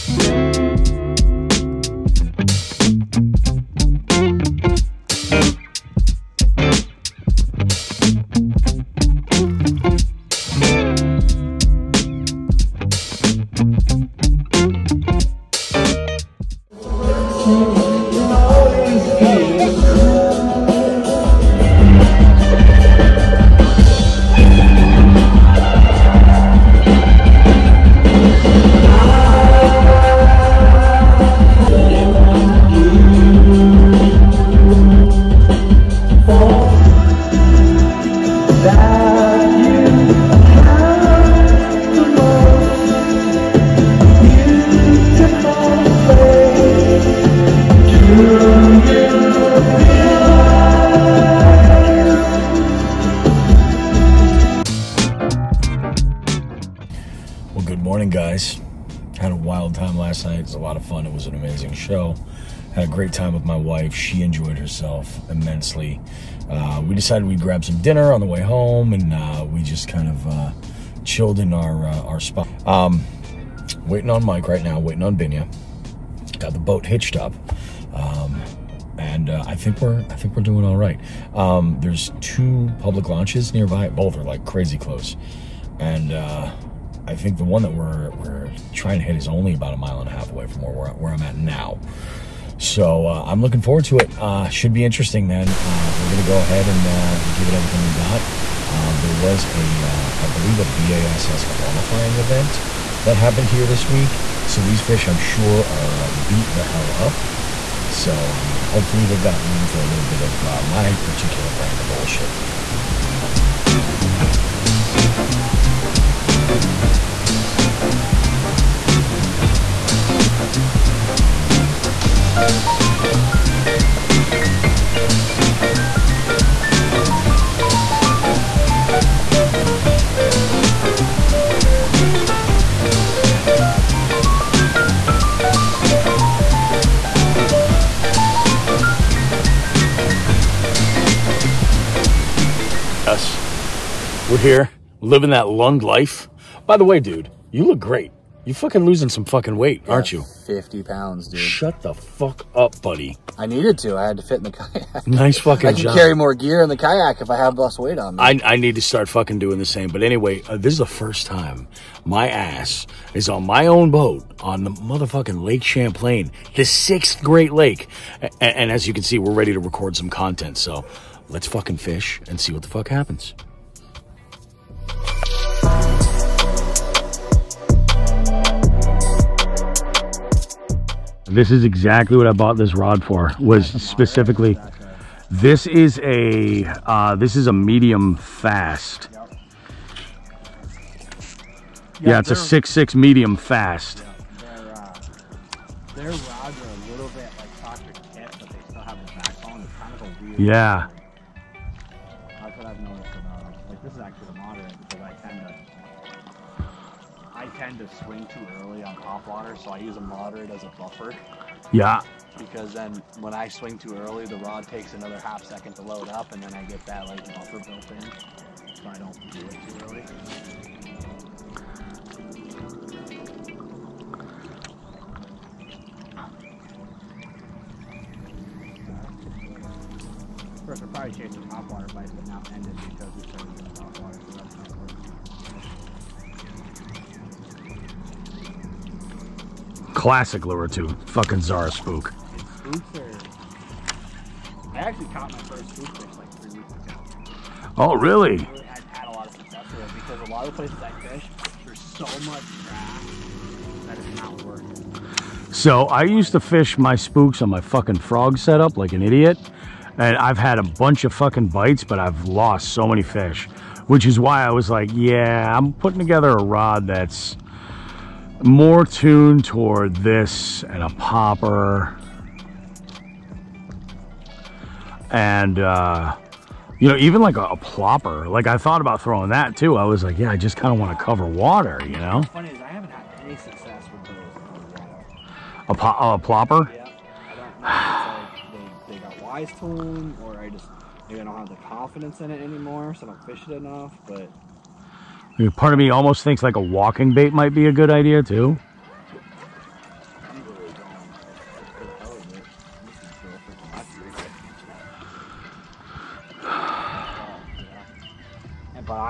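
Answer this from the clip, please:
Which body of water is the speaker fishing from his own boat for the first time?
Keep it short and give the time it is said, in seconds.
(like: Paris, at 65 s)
Lake Champlain, at 165 s.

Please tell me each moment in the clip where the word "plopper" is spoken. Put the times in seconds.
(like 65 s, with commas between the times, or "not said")
277 s, 286 s.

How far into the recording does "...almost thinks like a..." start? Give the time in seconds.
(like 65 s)
295 s.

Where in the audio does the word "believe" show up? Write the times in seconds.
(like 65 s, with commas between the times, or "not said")
100 s.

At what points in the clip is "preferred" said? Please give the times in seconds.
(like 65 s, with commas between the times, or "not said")
not said.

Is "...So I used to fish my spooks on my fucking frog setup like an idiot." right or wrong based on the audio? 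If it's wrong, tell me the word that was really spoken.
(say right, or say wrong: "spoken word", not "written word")
right.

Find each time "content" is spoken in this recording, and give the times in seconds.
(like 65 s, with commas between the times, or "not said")
170 s.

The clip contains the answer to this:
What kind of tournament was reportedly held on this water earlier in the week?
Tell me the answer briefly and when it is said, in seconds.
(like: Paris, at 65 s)
BASS qualifying event, at 100 s.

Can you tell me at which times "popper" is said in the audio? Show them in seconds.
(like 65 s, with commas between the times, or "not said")
270 s.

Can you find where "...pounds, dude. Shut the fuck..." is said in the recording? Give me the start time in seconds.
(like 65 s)
150 s.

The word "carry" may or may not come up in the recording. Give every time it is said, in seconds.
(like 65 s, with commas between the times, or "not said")
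155 s.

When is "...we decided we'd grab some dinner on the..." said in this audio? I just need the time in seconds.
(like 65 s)
66 s.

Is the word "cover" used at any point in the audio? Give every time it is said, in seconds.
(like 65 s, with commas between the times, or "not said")
281 s.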